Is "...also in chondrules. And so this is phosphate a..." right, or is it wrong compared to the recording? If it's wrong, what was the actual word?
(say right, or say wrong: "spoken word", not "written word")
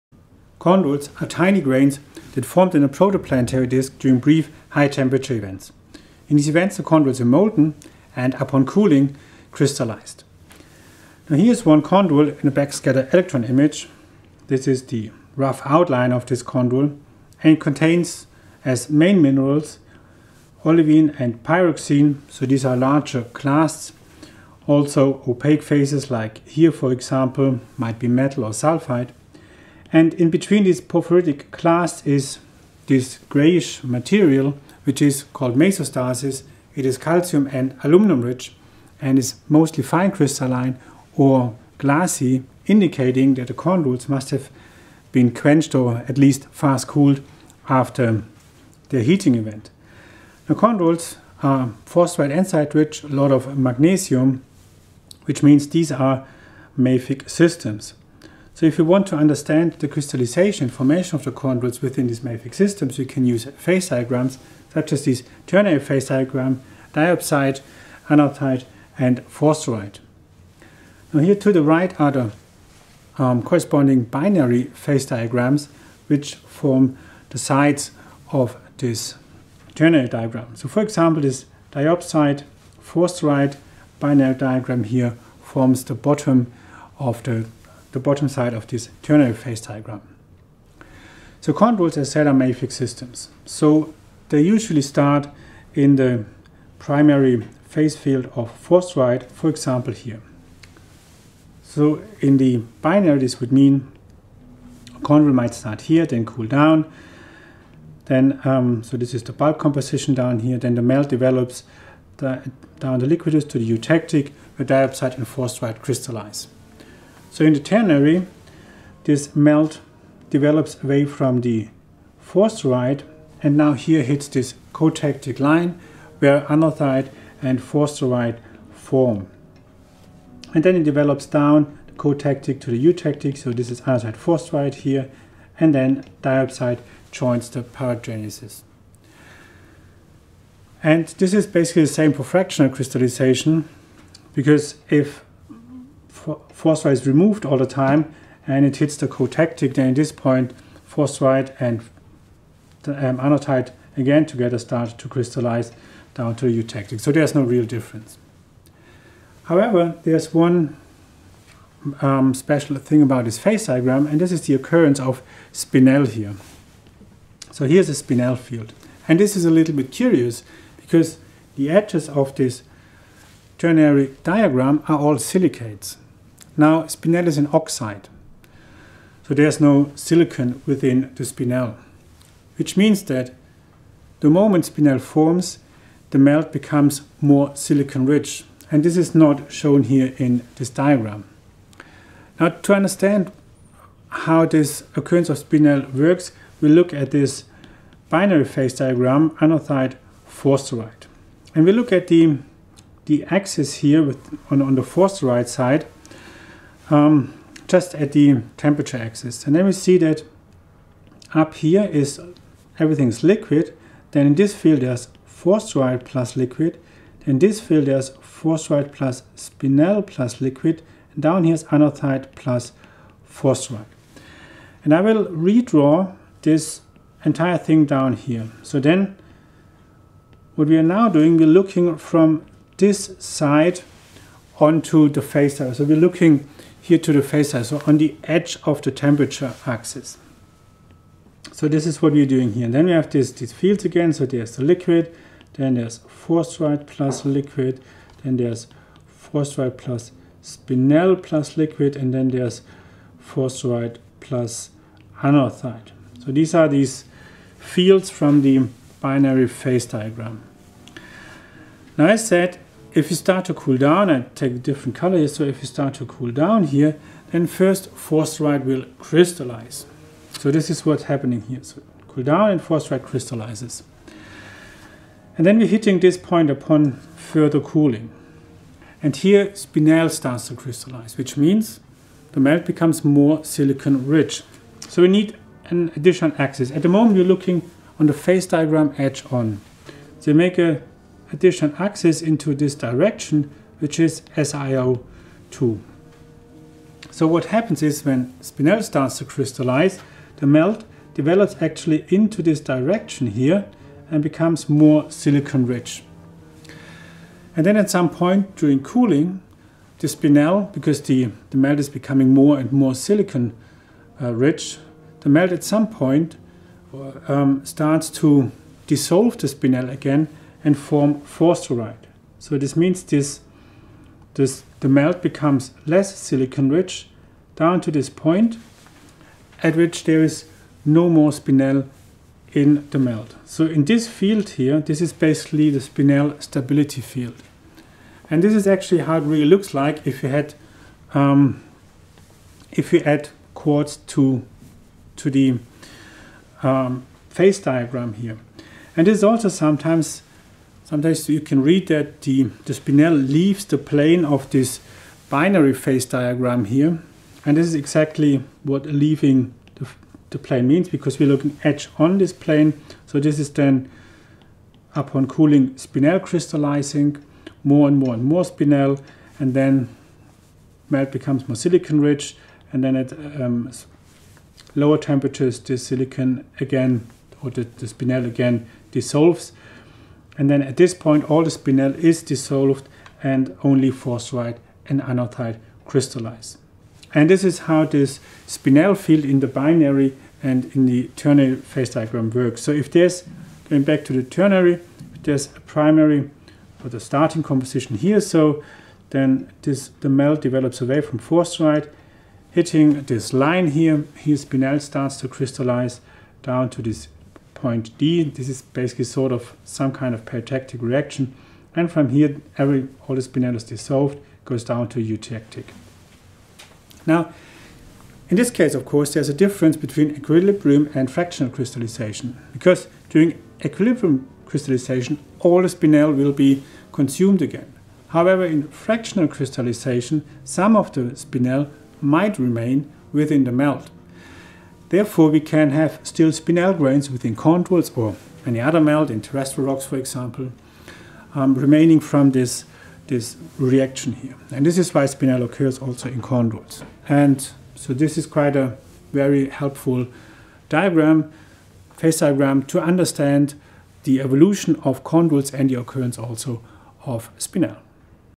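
wrong: "quite", not "phosphate".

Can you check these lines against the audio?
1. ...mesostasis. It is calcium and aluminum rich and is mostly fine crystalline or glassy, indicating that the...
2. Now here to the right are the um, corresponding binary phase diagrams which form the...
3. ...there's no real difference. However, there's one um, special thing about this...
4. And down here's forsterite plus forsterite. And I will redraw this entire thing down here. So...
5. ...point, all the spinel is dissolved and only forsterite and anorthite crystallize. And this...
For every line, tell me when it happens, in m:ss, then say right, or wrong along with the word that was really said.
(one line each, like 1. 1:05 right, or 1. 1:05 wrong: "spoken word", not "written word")
1. 0:35 right
2. 1:11 right
3. 2:37 right
4. 3:41 wrong: "anorthite", not "forsterite"
5. 6:20 right.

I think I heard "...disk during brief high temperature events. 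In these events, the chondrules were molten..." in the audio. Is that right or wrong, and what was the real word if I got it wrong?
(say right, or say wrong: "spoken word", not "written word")
right.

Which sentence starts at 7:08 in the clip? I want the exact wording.
However, in fractional crystallization, some of the spinel might remain within the melt.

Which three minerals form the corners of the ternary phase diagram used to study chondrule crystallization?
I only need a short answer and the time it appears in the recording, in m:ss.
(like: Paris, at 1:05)
diopside, anorthite, and forsterite, at 1:06.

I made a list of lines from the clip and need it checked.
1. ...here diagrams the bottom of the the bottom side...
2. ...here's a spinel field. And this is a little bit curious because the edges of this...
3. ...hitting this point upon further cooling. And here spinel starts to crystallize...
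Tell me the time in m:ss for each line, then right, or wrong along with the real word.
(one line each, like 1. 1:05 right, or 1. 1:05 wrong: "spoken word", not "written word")
1. 1:24 wrong: "forms", not "diagrams"
2. 2:47 right
3. 4:35 right.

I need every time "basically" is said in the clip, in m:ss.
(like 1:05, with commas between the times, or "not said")
2:21, 5:35, 6:48.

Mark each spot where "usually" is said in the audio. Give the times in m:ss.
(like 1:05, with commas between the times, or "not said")
1:34.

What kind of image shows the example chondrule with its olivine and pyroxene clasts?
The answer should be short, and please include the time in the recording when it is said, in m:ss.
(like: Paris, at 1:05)
backscatter electron image, at 0:12.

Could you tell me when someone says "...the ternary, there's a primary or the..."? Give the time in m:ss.
6:34.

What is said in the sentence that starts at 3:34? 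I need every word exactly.
Then in this field there's forsterite plus liquid.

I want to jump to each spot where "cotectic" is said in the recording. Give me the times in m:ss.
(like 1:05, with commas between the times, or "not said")
2:04, 2:11, 2:29.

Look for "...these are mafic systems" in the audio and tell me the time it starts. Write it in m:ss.
0:55.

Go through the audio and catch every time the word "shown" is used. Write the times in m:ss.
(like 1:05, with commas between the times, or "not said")
3:09.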